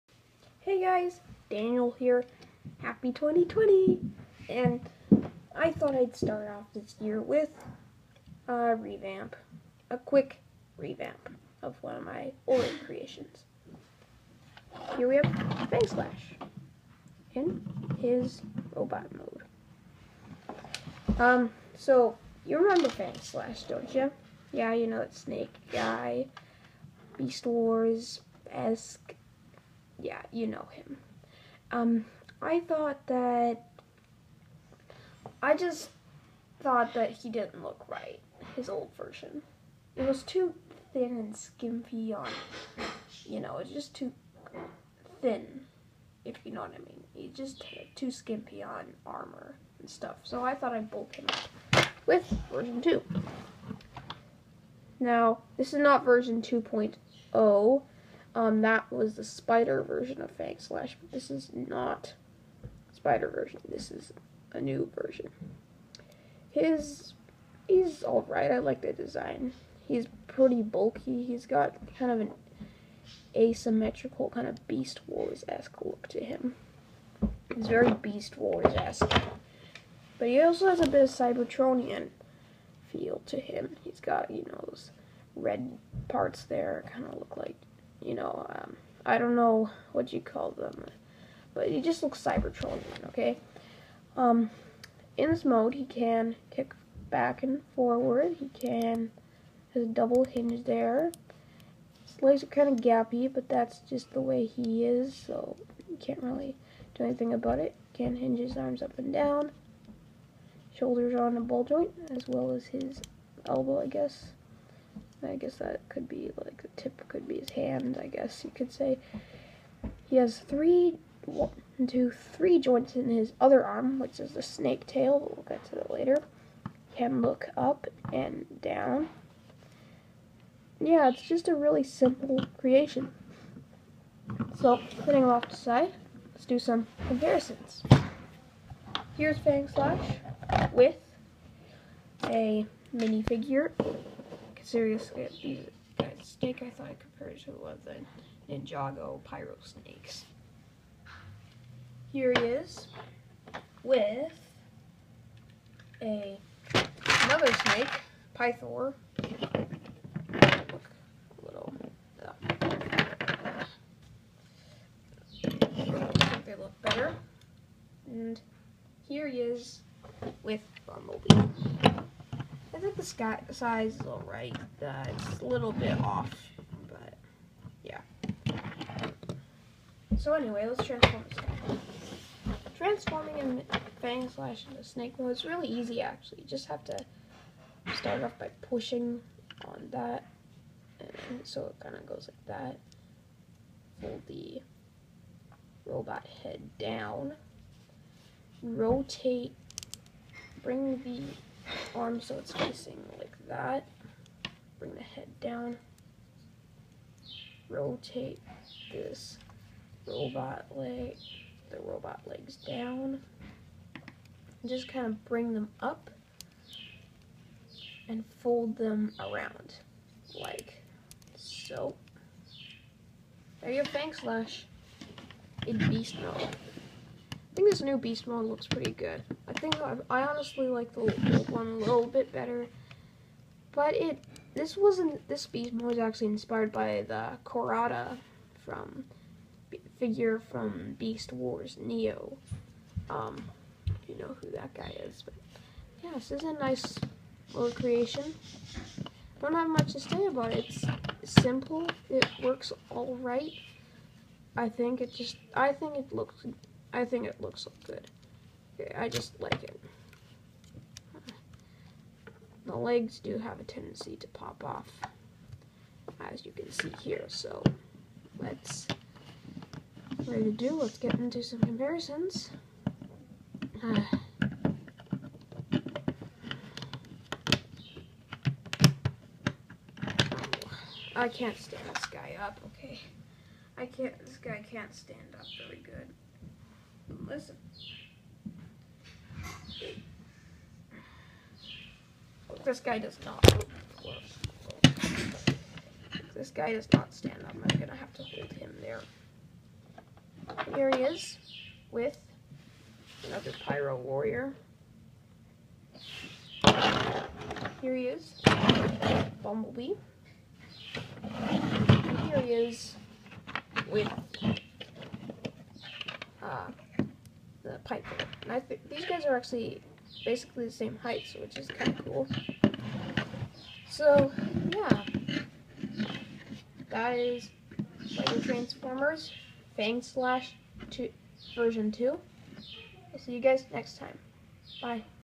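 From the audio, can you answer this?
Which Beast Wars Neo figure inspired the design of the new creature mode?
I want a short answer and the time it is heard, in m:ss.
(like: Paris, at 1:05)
Cohrada, at 3:57.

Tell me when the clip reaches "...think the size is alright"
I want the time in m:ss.
2:52.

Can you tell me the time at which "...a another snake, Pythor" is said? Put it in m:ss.
2:36.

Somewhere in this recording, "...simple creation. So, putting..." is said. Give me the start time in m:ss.
2:11.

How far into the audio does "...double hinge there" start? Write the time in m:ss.
1:39.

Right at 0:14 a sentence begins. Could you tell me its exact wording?
Here we have Fang Slash in his robot mode.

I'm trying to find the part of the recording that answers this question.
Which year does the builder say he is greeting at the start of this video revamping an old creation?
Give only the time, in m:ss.
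0:03.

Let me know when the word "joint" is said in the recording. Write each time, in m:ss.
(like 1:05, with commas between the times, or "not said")
1:51, 2:02.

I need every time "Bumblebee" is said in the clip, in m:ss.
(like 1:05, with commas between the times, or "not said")
2:50, 5:09.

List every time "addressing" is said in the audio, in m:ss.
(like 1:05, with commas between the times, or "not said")
not said.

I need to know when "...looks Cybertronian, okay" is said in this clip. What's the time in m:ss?
1:32.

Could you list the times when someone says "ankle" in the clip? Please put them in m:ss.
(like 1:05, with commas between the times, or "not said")
not said.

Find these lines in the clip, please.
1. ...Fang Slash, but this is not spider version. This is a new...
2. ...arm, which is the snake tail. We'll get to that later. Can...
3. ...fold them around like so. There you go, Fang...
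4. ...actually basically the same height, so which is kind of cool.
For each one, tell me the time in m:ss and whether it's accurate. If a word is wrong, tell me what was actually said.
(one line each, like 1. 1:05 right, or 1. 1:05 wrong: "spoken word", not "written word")
1. 1:00 right
2. 2:03 right
3. 3:38 right
4. 5:19 right.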